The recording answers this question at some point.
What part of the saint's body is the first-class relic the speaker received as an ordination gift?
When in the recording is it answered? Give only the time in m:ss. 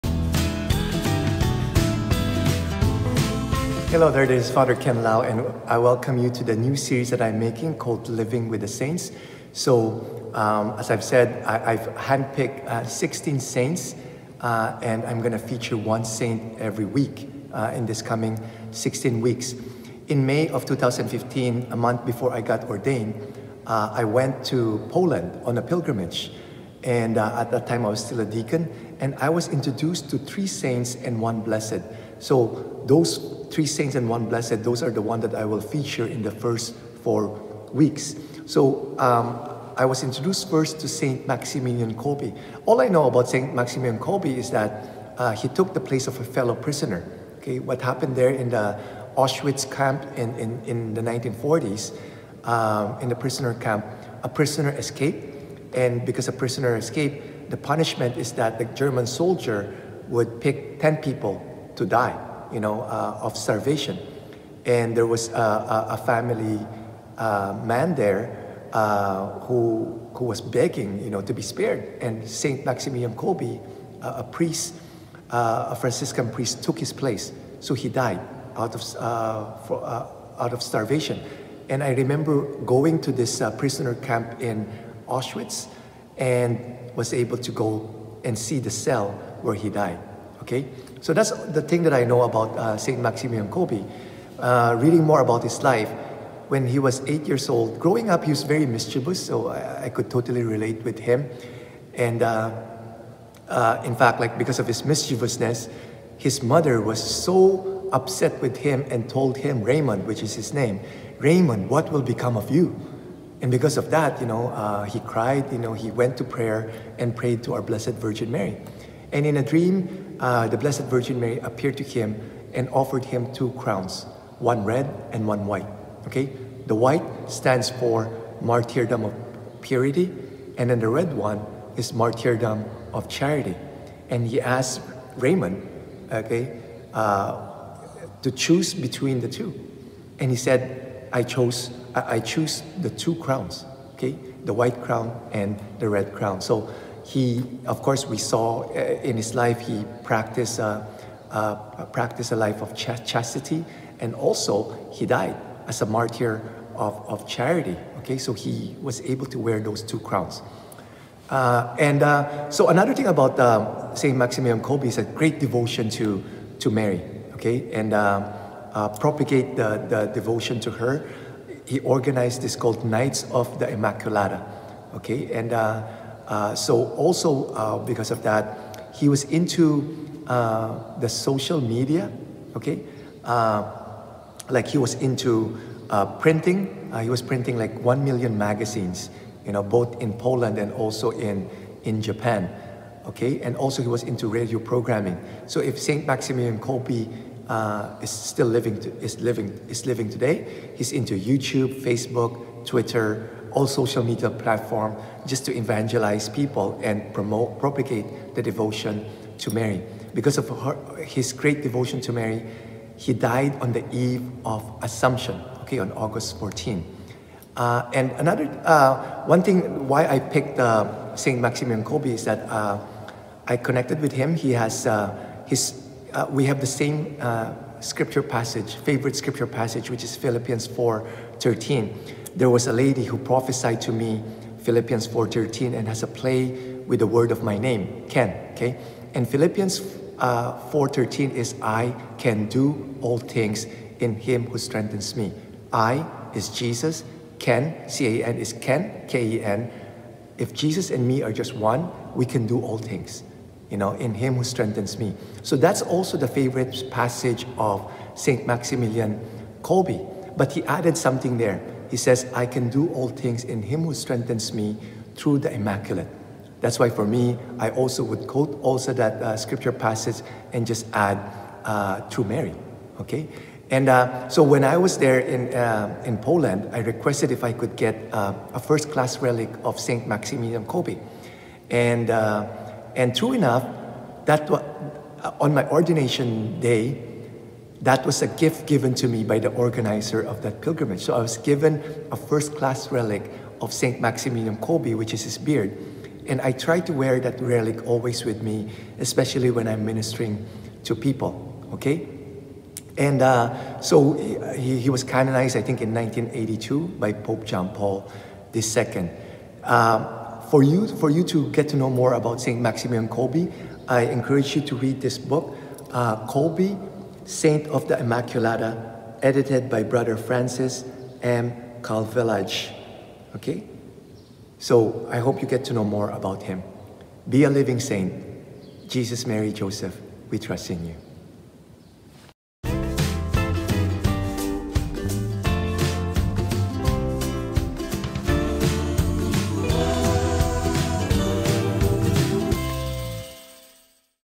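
4:55.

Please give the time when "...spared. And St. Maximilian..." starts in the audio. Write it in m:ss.
1:11.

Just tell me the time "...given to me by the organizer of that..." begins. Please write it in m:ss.
4:48.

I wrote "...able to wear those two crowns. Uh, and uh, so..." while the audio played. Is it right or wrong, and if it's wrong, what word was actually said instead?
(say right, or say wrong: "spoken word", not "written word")
right.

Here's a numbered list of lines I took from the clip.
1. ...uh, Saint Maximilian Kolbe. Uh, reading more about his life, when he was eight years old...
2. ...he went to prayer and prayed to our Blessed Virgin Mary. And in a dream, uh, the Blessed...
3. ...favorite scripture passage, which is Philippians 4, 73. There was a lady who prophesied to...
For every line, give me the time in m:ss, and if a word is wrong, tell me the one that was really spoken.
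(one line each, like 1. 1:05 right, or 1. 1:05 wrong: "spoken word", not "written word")
1. 1:32 right
2. 1:55 right
3. 3:48 wrong: "13", not "73".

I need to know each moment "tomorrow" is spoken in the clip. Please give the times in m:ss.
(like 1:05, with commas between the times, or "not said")
not said.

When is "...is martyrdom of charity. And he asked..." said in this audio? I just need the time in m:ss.
2:11.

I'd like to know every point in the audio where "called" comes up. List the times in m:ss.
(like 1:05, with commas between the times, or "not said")
0:07, 2:52.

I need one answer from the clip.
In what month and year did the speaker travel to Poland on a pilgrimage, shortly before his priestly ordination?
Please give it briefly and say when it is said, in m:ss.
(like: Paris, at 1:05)
May 2015, at 0:20.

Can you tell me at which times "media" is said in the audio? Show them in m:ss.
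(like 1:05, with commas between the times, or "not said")
3:01, 3:24.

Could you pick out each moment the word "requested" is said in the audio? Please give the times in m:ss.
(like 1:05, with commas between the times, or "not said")
4:36.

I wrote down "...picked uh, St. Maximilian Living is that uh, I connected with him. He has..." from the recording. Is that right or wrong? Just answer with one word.
wrong.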